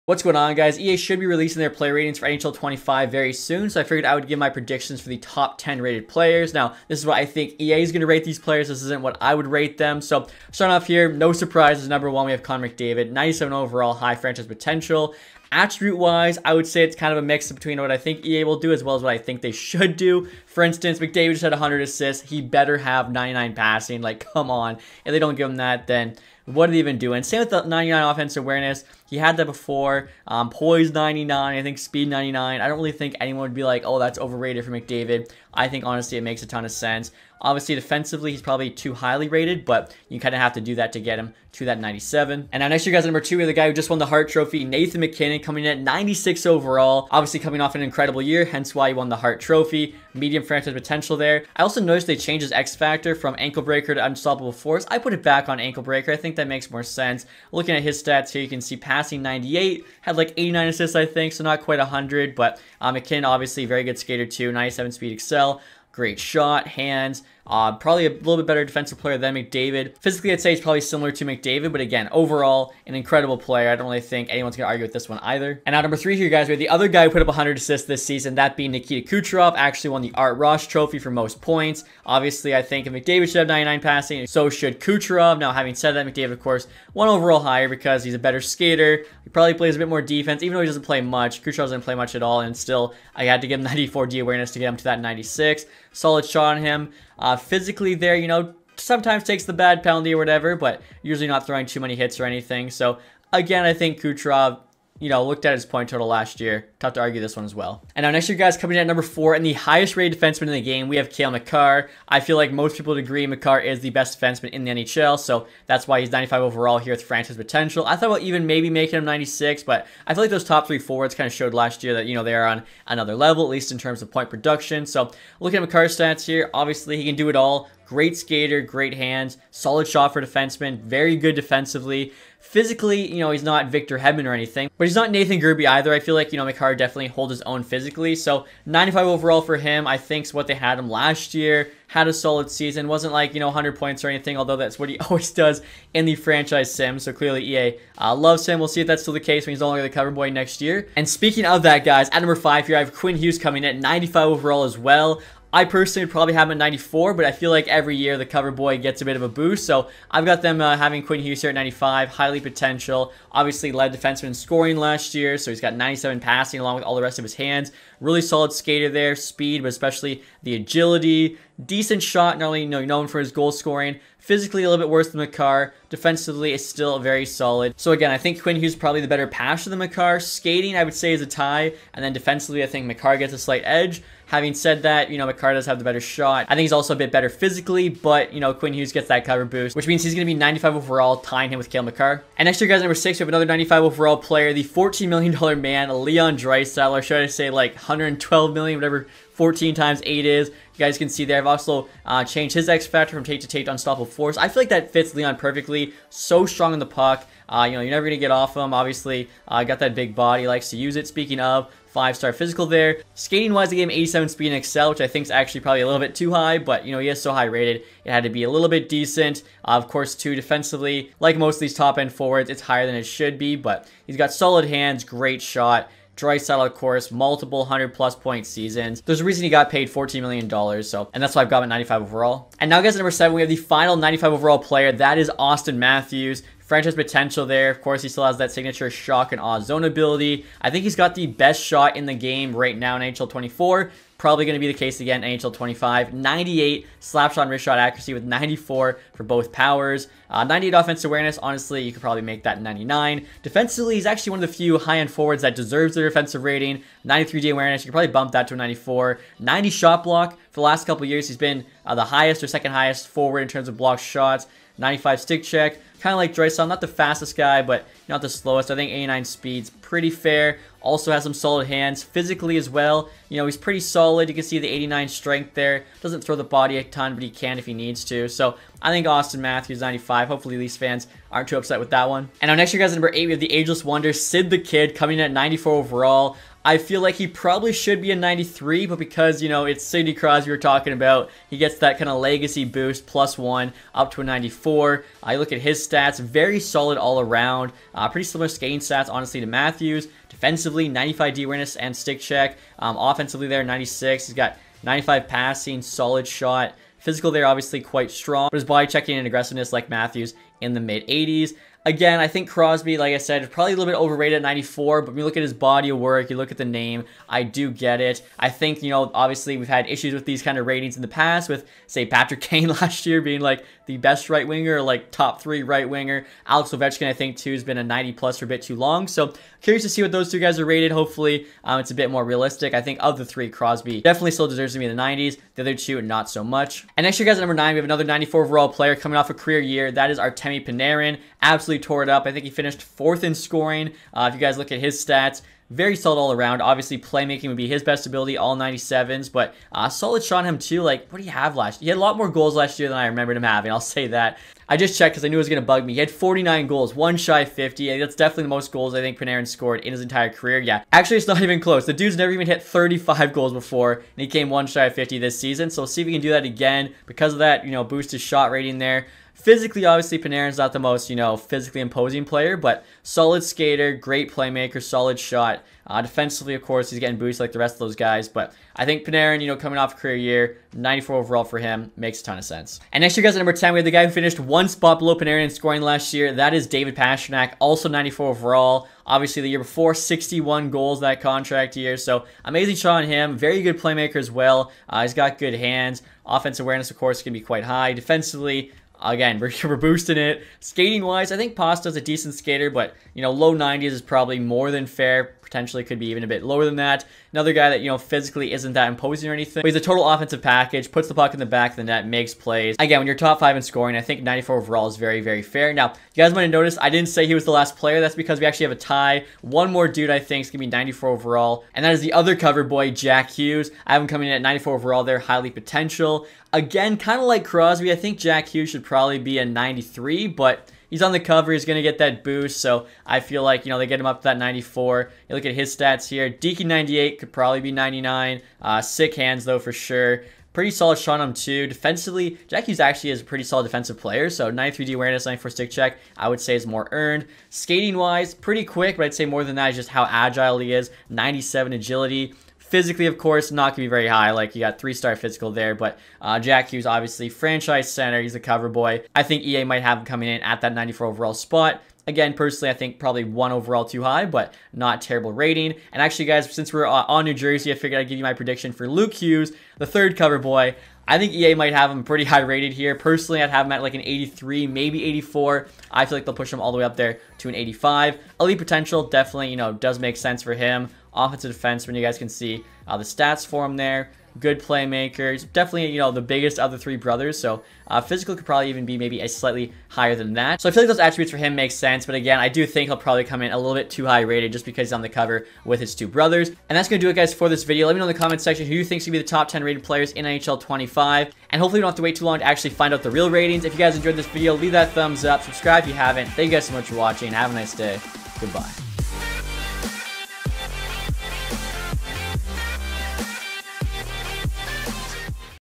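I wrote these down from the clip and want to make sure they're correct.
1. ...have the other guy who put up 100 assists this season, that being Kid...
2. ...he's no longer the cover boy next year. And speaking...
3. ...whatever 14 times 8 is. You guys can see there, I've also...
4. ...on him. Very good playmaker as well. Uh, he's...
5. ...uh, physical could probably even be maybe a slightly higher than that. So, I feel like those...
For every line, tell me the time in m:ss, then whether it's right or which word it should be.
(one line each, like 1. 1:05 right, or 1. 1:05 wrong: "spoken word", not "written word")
1. 1:16 wrong: "Nikita", not "Kid"
2. 2:29 right
3. 3:18 right
4. 6:33 right
5. 8:07 right.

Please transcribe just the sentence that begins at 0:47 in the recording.
Obviously coming off an incredible year, hence why he won the Hart Trophy.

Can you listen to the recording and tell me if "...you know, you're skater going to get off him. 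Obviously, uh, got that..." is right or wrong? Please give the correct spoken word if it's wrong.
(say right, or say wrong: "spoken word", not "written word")
wrong: "never", not "skater".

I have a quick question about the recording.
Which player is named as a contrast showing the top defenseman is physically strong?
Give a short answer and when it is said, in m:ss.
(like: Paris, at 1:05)
Nathan Gerbe, at 2:15.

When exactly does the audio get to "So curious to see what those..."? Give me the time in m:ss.
5:29.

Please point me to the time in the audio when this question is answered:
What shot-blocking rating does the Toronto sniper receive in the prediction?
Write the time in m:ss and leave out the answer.
4:19.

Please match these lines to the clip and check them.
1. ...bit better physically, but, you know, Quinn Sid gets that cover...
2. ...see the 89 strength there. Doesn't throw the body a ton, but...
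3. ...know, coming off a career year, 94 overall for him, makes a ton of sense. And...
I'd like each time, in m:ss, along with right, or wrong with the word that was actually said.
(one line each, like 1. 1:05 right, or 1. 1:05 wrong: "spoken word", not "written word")
1. 3:06 wrong: "Hughes", not "Sid"
2. 4:34 right
3. 6:19 right.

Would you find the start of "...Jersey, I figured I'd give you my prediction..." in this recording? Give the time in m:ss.
7:47.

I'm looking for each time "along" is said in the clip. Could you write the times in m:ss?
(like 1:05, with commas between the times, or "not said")
2:46.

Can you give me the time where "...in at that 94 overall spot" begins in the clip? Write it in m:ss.
7:40.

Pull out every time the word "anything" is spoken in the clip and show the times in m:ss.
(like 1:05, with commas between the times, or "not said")
1:42, 2:14, 2:24, 6:49.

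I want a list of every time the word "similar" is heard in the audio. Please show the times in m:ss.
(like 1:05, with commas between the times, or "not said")
1:10, 4:58.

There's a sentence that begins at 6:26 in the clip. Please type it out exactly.
That is David Pastrnak, also 94 overall.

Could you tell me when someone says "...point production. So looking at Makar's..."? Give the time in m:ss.
2:04.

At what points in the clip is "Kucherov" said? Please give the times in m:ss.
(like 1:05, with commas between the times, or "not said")
1:19, 1:24, 1:31, 1:44.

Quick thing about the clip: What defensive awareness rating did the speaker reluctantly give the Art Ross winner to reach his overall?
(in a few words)
94.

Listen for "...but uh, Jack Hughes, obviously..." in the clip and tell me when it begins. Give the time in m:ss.
7:35.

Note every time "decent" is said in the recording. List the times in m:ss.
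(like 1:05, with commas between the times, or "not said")
2:51, 3:38, 6:42.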